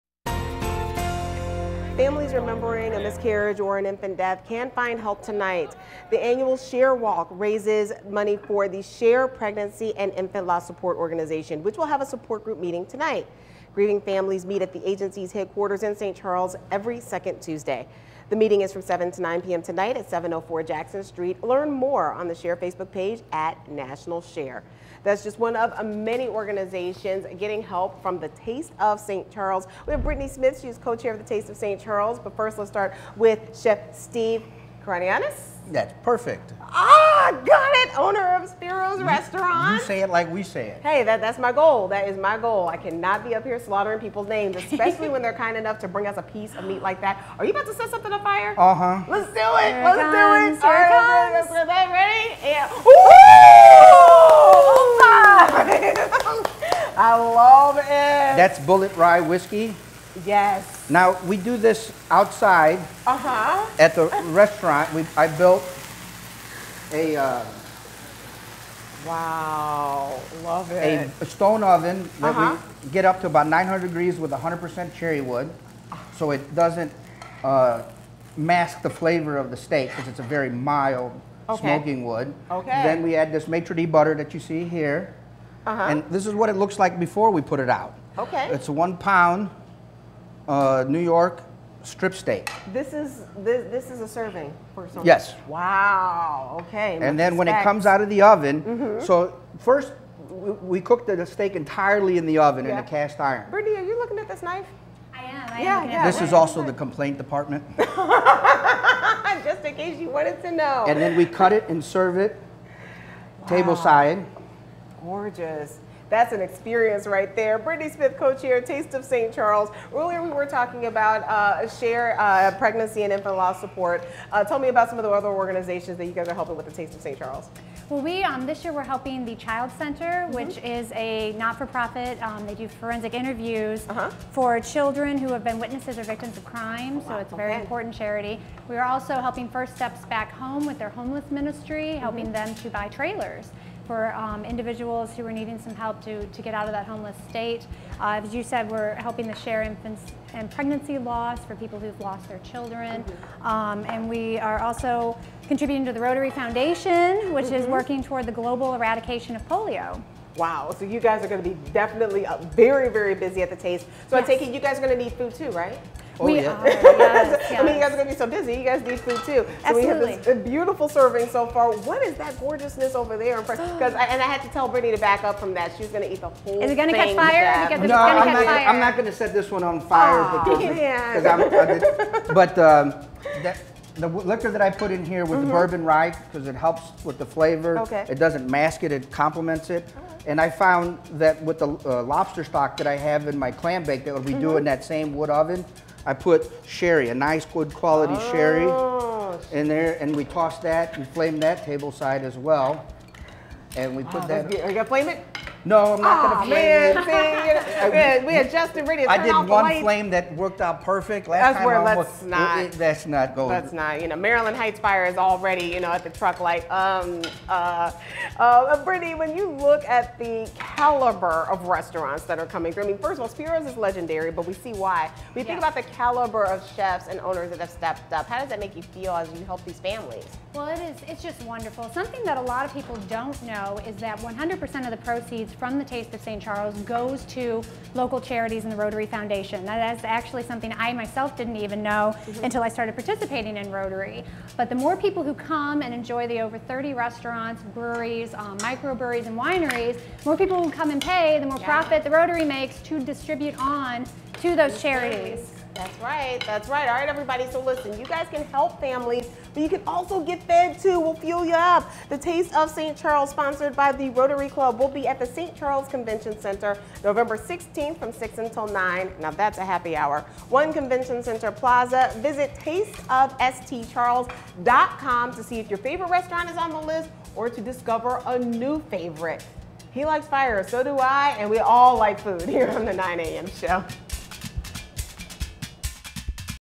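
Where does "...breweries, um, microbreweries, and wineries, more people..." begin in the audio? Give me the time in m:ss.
4:07.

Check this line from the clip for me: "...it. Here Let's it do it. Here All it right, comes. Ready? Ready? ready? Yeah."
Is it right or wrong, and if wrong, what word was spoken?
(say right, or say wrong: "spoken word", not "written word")
right.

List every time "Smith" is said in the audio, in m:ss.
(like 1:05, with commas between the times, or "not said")
0:30, 1:57.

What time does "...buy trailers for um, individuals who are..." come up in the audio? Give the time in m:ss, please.
2:22.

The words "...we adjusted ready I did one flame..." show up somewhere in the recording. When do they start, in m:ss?
3:28.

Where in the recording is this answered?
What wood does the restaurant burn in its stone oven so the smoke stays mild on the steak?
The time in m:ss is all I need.
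1:14.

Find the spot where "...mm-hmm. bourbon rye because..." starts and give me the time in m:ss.
3:05.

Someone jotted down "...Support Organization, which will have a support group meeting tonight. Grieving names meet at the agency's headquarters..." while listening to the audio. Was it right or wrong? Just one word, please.
wrong.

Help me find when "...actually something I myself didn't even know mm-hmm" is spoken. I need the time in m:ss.
4:00.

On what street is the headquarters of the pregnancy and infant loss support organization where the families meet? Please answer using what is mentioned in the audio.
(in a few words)
Jackson Street.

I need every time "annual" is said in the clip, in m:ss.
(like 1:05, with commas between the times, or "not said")
0:06.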